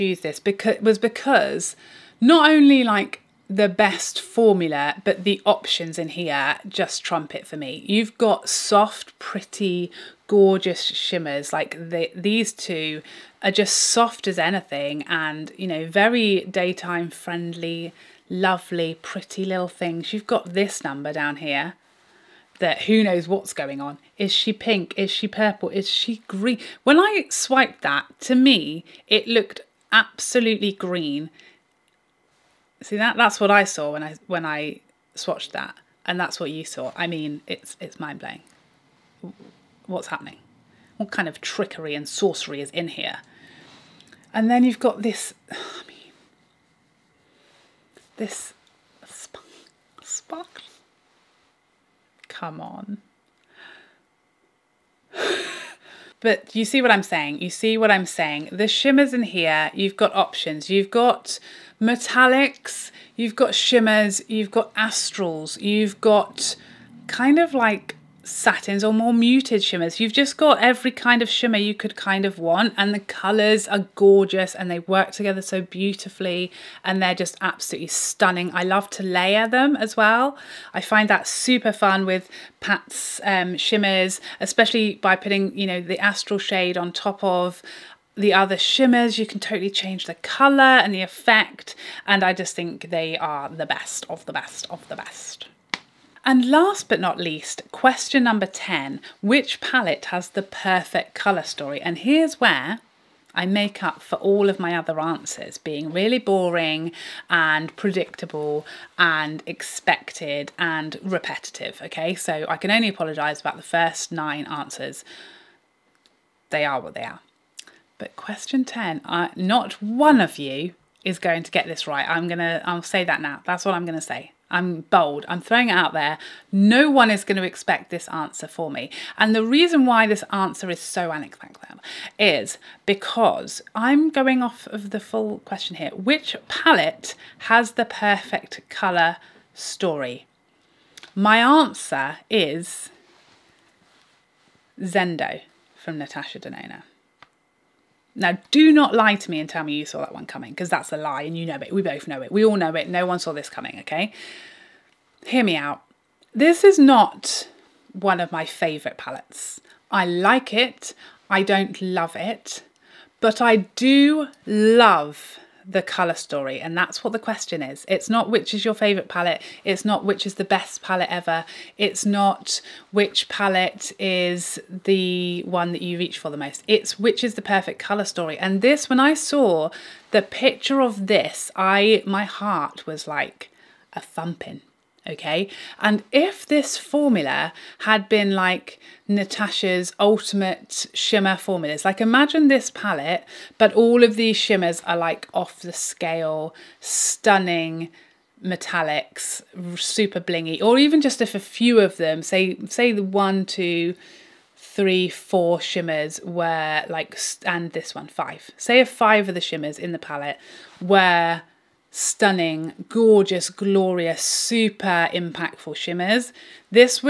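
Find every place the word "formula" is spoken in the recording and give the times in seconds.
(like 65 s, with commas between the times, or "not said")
4 s, 186 s, 191 s.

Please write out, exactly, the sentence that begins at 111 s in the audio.
Okay, so I can only apologize about the first nine answers.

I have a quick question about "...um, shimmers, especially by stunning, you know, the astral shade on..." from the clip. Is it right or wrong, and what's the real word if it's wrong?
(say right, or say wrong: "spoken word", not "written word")
wrong: "putting", not "stunning".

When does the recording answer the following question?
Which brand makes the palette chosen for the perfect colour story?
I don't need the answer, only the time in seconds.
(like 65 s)
145 s.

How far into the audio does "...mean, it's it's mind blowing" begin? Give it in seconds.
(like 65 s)
37 s.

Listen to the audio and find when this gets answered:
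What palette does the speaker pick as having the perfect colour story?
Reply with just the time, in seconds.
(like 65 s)
144 s.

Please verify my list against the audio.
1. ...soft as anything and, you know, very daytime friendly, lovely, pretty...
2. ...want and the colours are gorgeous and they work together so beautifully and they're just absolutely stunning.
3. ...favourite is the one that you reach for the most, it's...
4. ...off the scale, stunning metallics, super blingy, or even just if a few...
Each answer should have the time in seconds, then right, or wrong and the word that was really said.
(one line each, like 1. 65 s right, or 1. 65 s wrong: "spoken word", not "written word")
1. 13 s right
2. 72 s right
3. 173 s wrong: "palette", not "favourite"
4. 195 s right.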